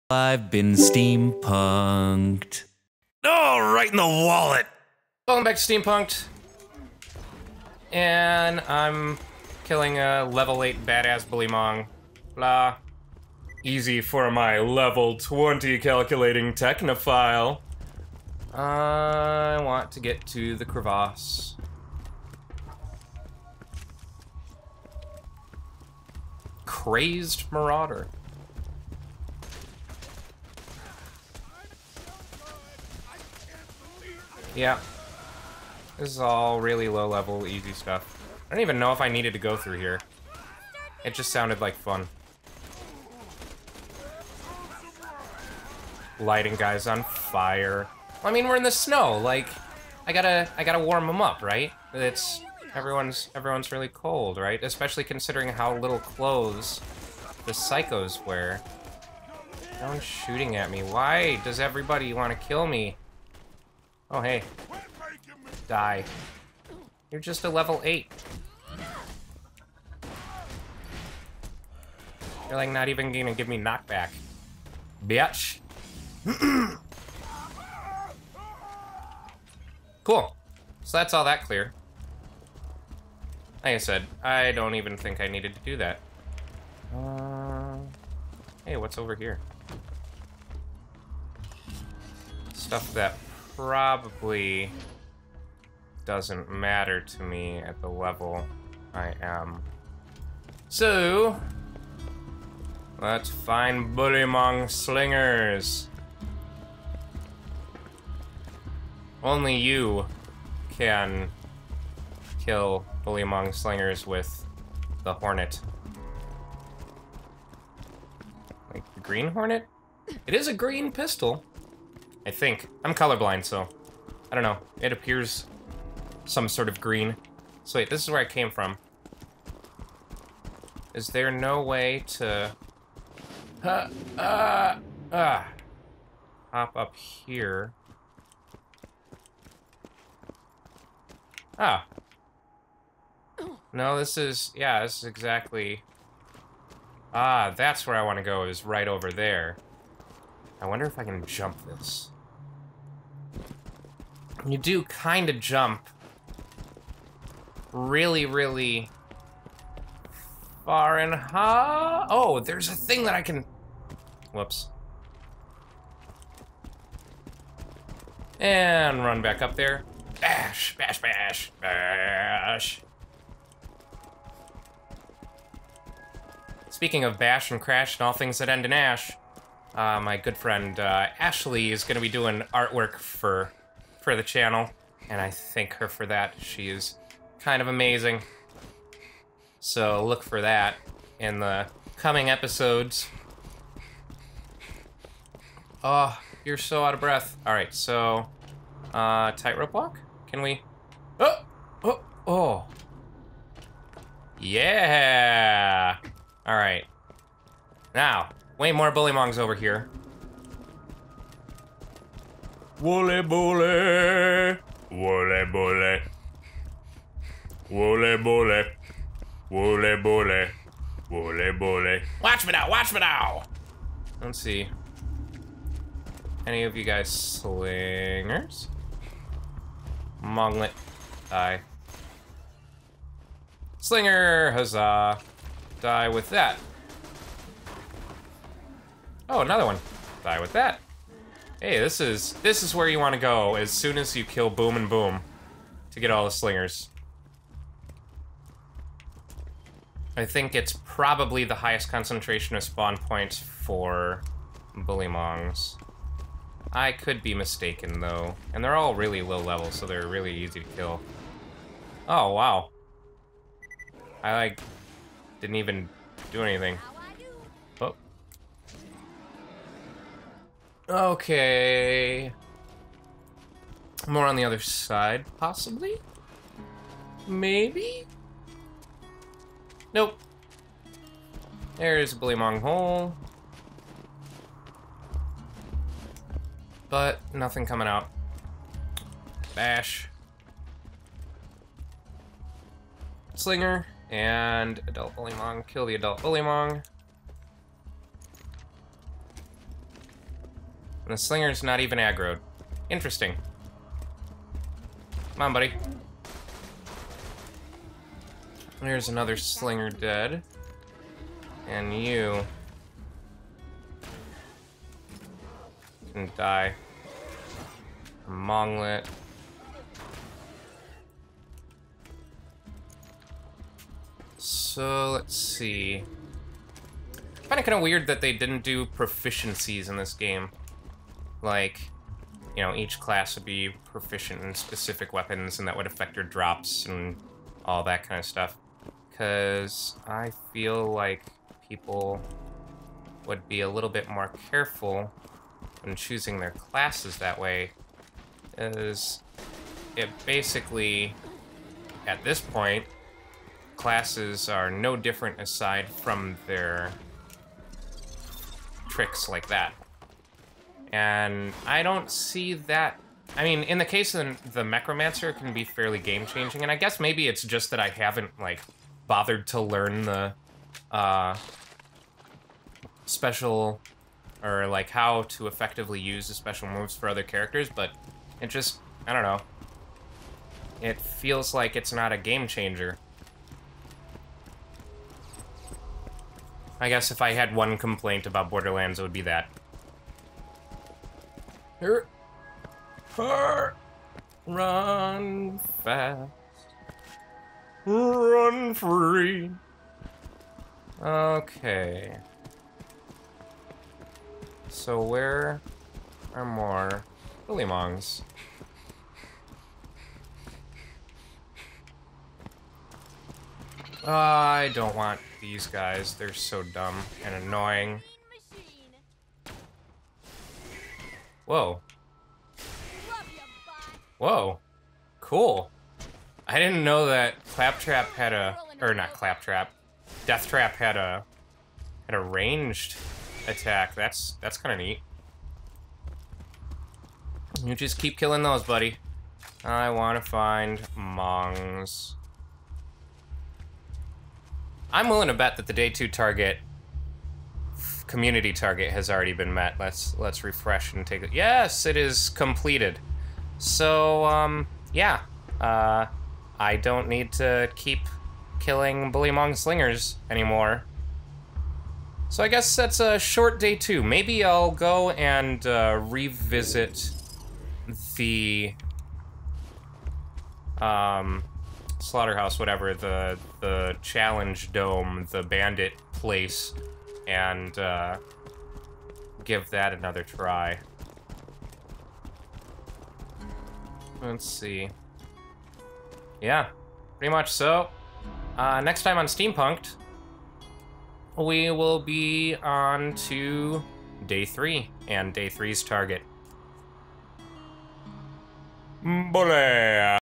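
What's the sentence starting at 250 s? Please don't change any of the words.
I think it's probably the highest concentration of spawn points for Bullymongs.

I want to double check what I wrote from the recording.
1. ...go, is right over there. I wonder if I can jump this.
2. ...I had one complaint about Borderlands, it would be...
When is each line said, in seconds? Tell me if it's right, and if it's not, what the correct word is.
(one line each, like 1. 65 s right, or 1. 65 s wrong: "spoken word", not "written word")
1. 148 s right
2. 387 s right.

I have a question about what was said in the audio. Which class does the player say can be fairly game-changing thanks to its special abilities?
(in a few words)
Mechromancer.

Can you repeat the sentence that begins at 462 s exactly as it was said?
So I guess that's a short day too.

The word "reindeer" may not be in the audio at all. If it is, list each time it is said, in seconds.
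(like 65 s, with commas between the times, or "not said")
not said.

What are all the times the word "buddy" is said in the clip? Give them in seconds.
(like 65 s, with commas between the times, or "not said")
305 s, 438 s.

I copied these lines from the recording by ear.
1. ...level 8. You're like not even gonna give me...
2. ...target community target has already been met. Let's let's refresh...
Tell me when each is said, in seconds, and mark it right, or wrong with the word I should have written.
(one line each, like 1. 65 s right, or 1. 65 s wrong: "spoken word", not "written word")
1. 67 s right
2. 446 s right.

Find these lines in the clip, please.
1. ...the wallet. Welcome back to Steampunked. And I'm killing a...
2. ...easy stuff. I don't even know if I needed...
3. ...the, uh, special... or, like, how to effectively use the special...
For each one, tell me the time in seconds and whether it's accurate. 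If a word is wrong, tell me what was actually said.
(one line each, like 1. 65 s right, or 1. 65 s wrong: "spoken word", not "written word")
1. 3 s right
2. 37 s right
3. 370 s right.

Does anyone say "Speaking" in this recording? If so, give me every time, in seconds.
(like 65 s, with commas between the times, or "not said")
176 s.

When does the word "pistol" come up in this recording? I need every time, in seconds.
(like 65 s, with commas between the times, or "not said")
120 s.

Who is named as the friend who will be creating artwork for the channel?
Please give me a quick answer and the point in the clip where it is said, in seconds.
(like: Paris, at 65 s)
Ashley, at 181 s.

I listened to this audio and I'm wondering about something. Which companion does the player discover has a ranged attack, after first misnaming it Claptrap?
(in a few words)
Deathtrap.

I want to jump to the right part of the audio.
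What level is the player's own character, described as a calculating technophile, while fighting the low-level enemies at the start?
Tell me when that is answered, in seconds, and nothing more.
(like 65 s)
14 s.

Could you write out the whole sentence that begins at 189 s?
So look for that in the coming episodes.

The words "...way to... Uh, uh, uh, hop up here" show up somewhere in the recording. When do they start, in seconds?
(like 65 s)
131 s.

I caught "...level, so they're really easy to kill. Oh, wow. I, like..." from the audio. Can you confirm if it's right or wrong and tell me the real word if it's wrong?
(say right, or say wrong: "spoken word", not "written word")
right.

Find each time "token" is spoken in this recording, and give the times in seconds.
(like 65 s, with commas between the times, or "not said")
not said.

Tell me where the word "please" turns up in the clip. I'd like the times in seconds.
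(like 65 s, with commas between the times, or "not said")
not said.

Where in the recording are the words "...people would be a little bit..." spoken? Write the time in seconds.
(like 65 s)
341 s.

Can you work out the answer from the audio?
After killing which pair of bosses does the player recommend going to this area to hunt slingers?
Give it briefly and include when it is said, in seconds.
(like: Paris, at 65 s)
Boom and Bewm, at 244 s.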